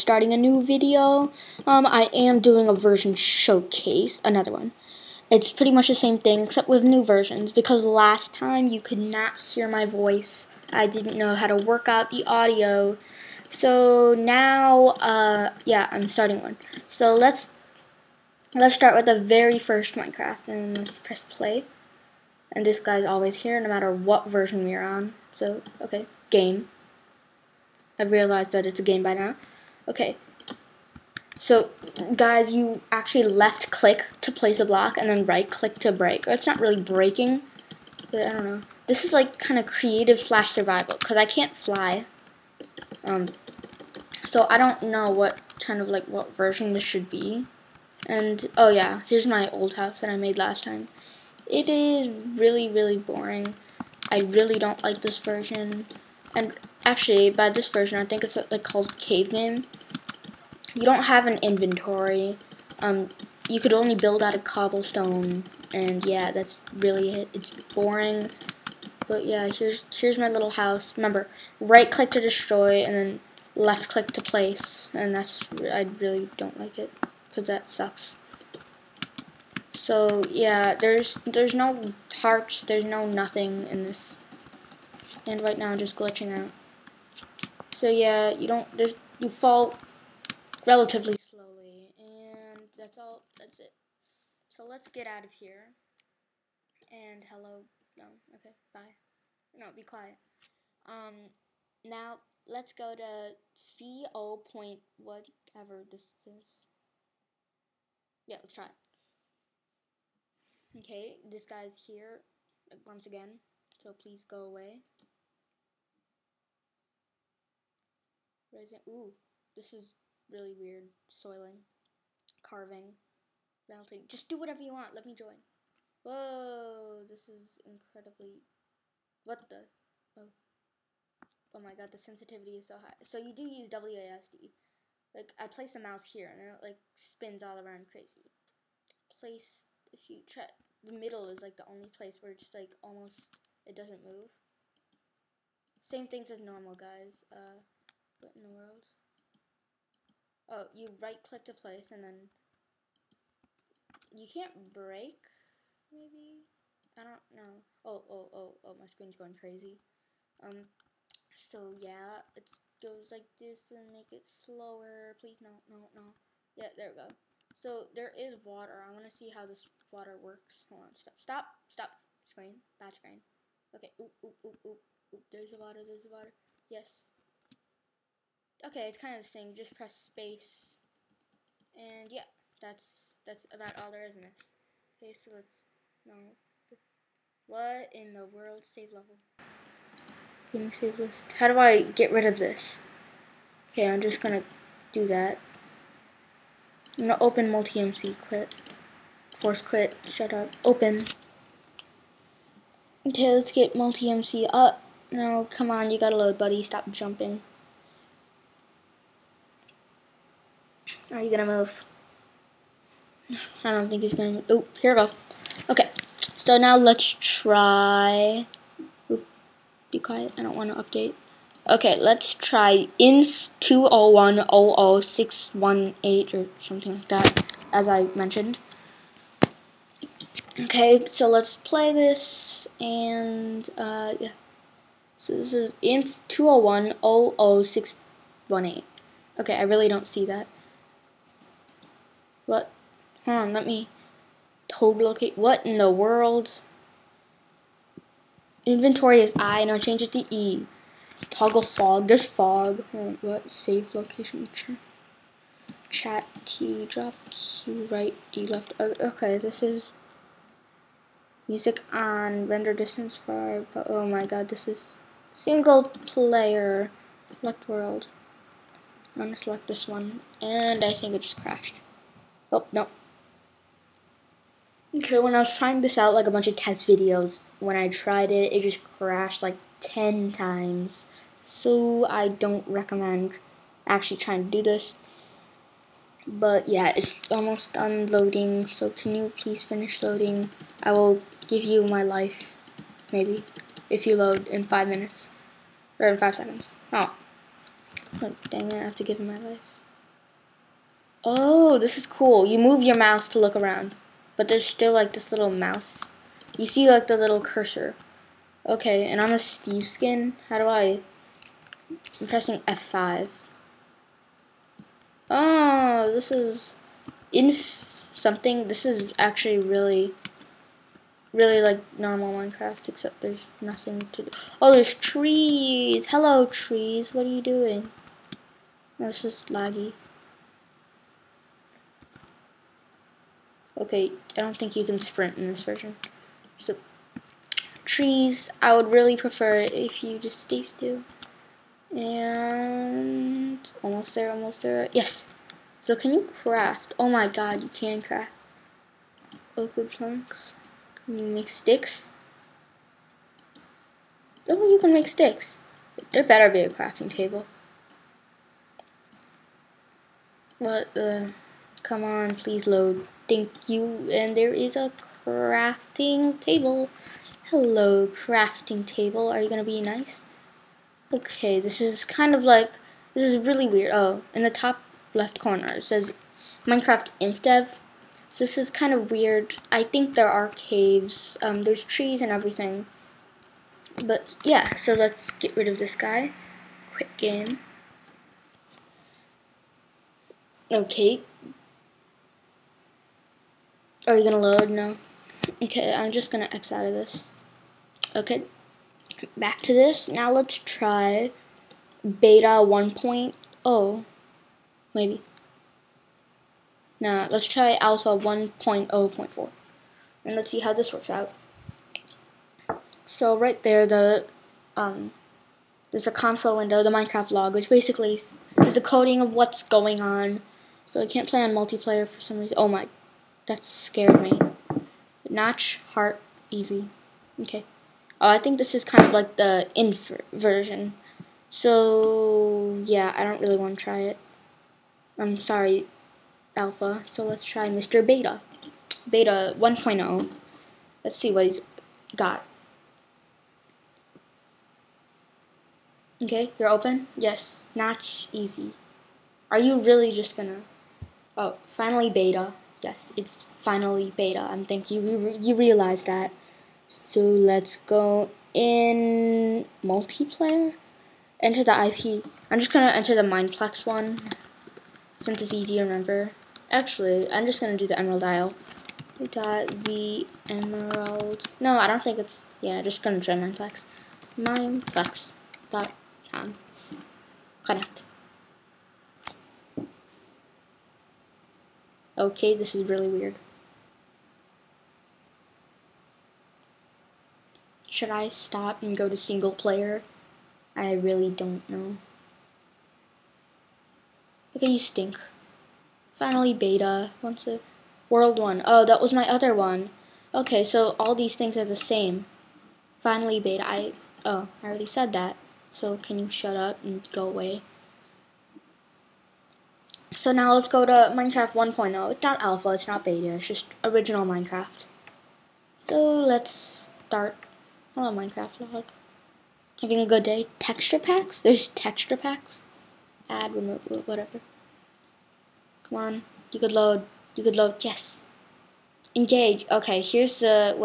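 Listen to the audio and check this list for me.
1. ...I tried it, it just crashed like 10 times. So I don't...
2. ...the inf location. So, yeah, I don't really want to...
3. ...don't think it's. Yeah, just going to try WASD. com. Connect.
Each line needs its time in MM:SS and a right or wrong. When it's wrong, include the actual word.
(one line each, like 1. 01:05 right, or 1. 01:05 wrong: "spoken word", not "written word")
1. 04:37 right
2. 07:09 wrong: "version", not "location"
3. 07:51 wrong: "Mineplex", not "WASD".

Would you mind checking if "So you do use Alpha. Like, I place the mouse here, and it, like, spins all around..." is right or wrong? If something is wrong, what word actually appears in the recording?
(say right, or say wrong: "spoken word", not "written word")
wrong: "WASD", not "Alpha".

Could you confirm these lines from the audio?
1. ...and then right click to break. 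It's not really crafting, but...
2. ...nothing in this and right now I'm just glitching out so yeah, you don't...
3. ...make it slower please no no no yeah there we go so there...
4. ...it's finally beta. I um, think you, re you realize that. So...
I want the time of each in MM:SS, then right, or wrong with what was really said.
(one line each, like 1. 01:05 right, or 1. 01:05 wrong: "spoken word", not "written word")
1. 00:34 wrong: "breaking", not "crafting"
2. 01:23 right
3. 02:43 right
4. 07:33 right.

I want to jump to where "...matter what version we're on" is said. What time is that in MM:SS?
00:23.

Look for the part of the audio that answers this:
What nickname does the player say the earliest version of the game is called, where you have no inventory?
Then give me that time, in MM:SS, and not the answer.
00:58.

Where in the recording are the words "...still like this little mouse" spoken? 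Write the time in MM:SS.
05:04.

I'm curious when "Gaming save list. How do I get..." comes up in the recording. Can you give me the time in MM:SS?
03:10.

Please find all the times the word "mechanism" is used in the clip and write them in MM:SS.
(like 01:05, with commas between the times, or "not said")
not said.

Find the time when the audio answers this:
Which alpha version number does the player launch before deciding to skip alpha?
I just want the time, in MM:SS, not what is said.
06:48.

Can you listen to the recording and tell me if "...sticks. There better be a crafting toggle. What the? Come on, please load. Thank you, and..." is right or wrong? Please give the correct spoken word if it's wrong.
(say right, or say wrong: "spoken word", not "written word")
wrong: "table", not "toggle".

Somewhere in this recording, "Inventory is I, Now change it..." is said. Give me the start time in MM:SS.
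04:08.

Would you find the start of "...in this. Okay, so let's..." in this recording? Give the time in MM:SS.
03:04.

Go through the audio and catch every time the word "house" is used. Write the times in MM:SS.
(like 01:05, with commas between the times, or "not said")
00:49, 01:10.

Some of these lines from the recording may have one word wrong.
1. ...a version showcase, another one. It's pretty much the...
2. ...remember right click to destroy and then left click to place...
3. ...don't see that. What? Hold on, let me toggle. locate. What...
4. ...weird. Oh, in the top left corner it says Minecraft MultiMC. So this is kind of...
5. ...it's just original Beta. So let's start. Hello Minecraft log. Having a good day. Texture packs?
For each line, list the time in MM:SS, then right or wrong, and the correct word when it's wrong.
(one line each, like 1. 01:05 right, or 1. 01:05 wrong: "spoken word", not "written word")
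1. 00:02 right
2. 01:10 right
3. 03:59 right
4. 06:13 wrong: "InfDev", not "MultiMC"
5. 08:33 wrong: "Minecraft", not "Beta".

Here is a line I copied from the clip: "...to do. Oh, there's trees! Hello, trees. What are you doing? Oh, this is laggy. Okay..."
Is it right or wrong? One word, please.
right.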